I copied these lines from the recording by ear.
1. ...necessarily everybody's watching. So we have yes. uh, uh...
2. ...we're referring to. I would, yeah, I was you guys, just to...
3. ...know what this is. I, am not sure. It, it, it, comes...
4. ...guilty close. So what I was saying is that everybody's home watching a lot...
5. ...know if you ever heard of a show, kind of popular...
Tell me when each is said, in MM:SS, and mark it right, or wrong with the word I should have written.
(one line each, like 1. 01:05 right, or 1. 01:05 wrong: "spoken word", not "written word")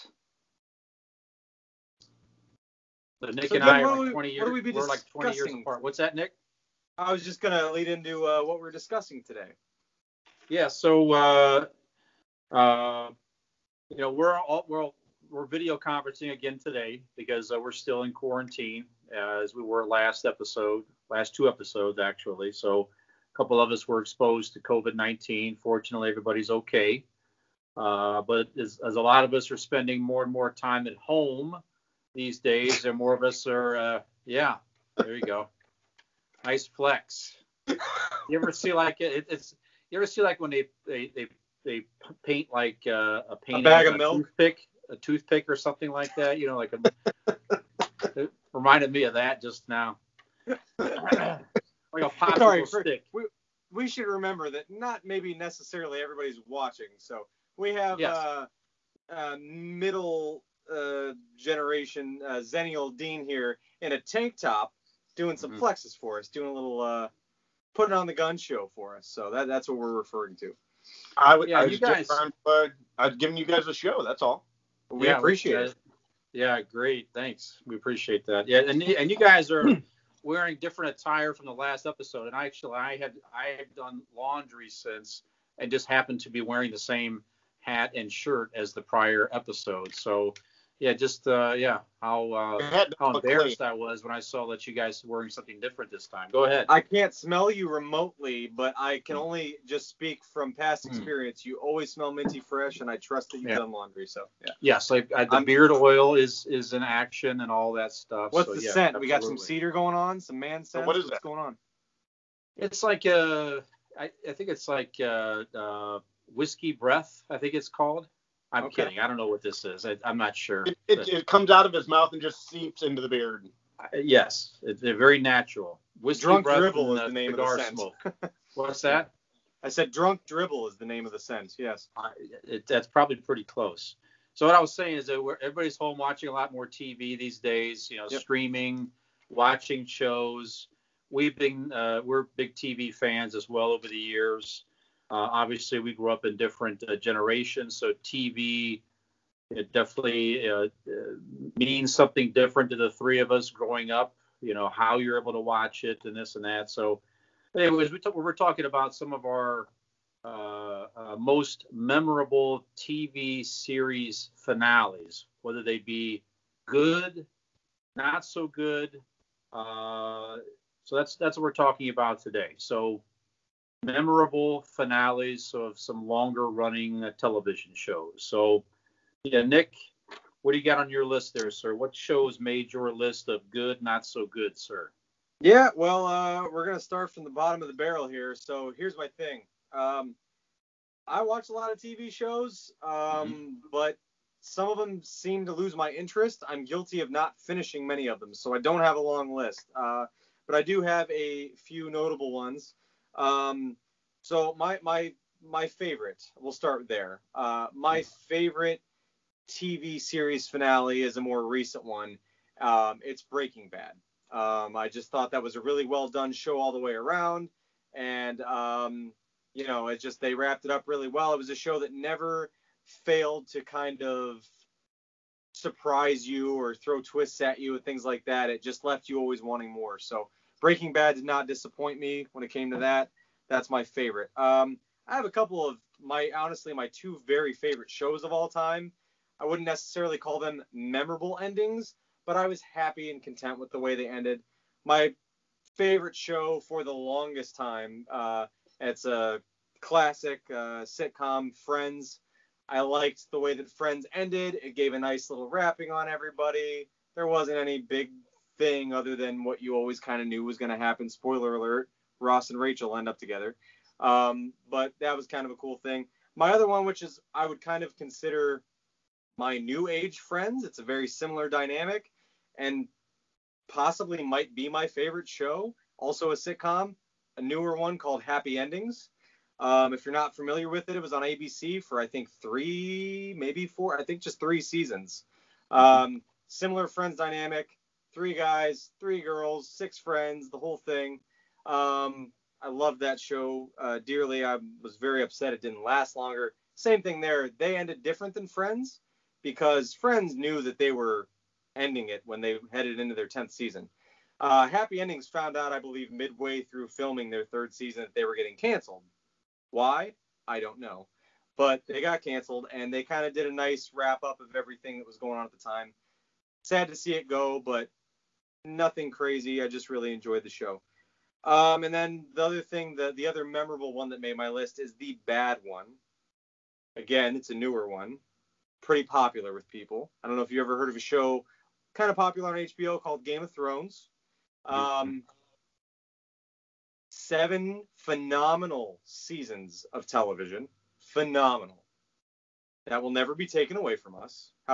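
1. 00:55 right
2. 01:09 right
3. 01:59 right
4. 02:13 wrong: "pretty", not "guilty"
5. 05:30 right.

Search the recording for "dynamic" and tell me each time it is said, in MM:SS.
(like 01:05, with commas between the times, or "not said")
04:31, 04:47.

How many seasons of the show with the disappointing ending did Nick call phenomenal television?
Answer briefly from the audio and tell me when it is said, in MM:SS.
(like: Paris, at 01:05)
7, at 05:37.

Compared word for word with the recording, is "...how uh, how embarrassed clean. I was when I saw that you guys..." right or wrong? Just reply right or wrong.
right.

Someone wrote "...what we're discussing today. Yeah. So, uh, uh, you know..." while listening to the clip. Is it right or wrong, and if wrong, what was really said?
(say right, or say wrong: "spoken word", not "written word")
right.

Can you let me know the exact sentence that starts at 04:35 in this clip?
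Also a sitcom, a newer one called Happy Endings.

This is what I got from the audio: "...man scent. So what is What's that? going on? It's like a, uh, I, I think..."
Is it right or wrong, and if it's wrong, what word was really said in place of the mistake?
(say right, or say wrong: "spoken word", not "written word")
right.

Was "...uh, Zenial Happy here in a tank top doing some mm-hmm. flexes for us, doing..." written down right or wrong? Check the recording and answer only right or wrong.
wrong.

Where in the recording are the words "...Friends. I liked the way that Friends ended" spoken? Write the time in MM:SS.
04:11.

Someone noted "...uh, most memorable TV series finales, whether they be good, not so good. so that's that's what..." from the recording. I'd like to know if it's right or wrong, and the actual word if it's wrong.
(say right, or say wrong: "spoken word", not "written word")
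right.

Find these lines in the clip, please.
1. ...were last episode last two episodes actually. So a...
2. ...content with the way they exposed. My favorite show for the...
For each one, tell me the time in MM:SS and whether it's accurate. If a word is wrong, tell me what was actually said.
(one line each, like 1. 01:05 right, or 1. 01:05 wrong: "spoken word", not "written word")
1. 00:19 right
2. 04:03 wrong: "ended", not "exposed".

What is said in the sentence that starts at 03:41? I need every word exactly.
It was a show that never failed to kind of surprise you or throw twists at you and things like that.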